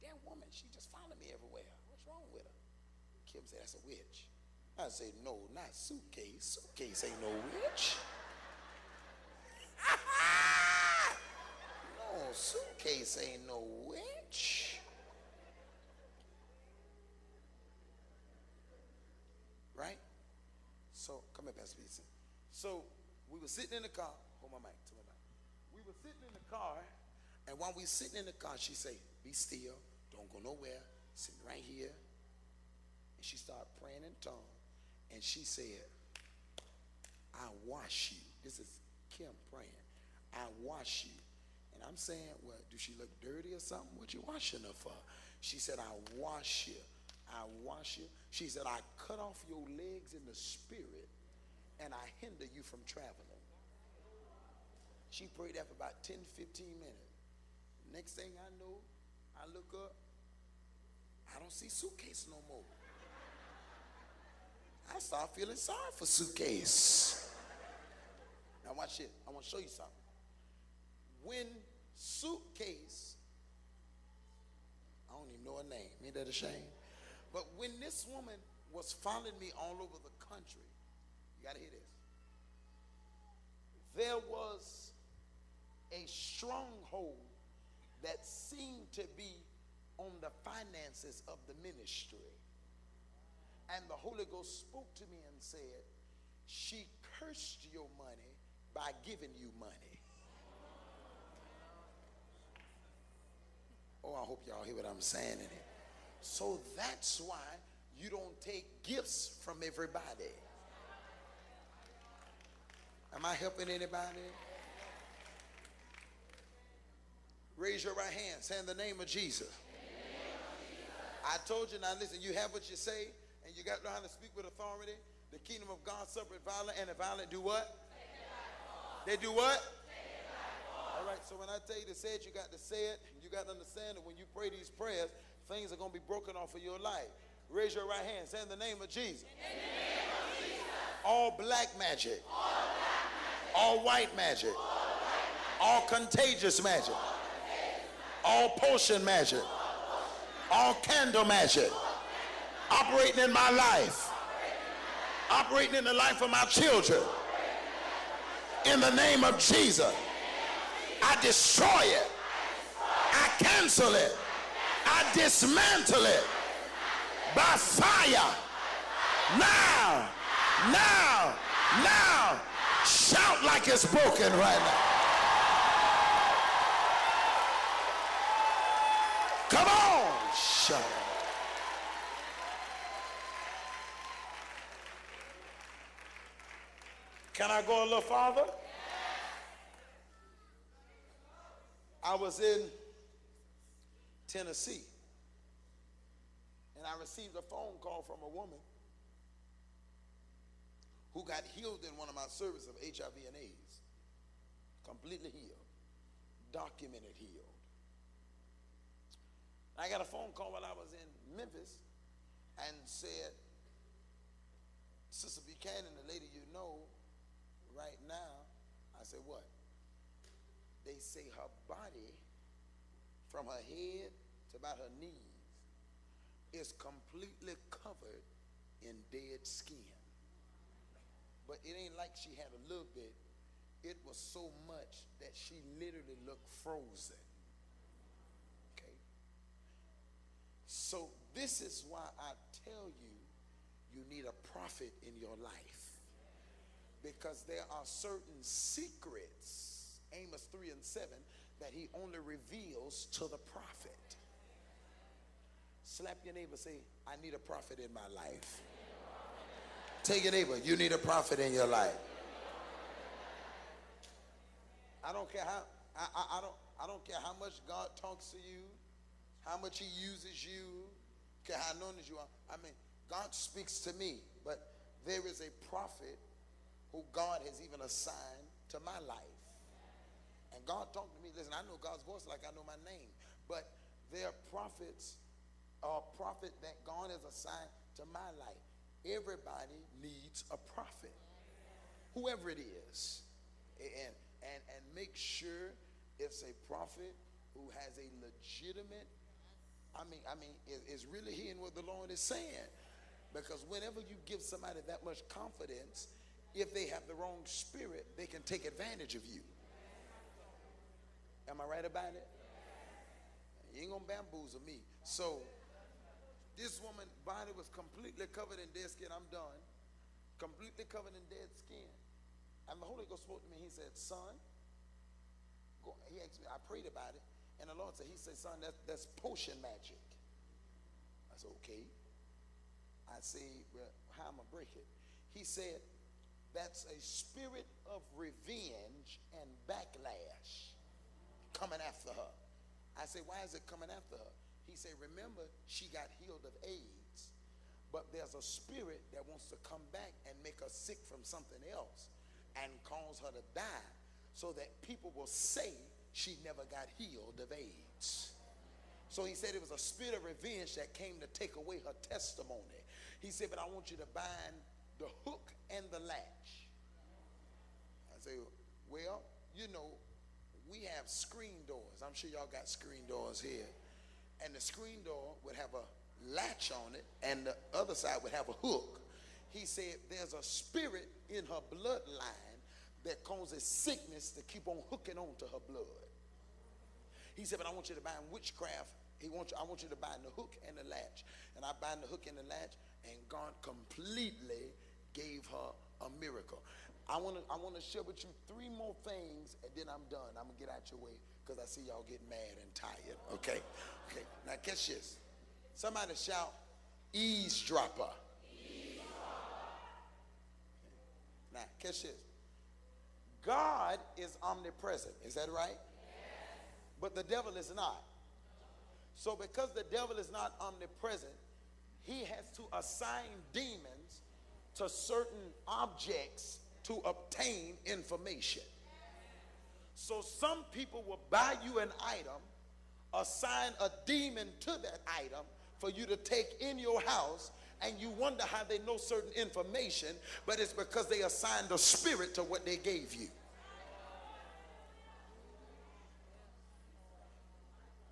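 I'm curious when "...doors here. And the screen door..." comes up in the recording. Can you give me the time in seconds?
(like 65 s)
373 s.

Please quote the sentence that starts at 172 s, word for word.
Shout like it's broken right now.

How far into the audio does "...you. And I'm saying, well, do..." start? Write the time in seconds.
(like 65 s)
41 s.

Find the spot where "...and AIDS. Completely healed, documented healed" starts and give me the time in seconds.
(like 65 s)
203 s.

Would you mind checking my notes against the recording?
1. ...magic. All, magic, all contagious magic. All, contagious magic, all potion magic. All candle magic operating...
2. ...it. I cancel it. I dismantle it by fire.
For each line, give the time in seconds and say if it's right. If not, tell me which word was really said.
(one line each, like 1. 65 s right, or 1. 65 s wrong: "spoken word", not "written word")
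1. 144 s right
2. 161 s right.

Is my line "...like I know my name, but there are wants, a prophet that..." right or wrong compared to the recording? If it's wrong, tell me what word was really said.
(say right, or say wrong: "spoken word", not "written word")
wrong: "prophets", not "wants".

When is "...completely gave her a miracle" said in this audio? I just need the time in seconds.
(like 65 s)
393 s.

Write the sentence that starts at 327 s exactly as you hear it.
And the Lord said, He said, Son, that's, that's potion magic.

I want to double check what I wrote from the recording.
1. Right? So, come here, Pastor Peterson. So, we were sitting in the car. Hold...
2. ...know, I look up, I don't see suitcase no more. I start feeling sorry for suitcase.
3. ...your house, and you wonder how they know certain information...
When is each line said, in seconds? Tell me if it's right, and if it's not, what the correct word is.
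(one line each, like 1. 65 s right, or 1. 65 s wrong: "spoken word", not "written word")
1. 19 s right
2. 58 s right
3. 436 s right.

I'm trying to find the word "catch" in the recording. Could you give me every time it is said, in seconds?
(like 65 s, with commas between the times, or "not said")
404 s, 411 s.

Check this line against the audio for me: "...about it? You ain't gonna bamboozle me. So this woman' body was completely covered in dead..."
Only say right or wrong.
right.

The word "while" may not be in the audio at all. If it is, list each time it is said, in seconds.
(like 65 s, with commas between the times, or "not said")
27 s, 210 s.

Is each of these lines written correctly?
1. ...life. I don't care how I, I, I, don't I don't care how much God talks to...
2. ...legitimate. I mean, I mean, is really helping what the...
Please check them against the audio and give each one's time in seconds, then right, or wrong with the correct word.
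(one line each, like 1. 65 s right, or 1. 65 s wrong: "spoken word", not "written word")
1. 261 s right
2. 298 s wrong: "hearing", not "helping".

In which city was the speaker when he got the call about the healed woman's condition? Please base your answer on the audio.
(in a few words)
Memphis.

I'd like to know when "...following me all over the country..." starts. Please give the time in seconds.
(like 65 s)
79 s.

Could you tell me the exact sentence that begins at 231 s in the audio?
But it ain't like she had a little bit.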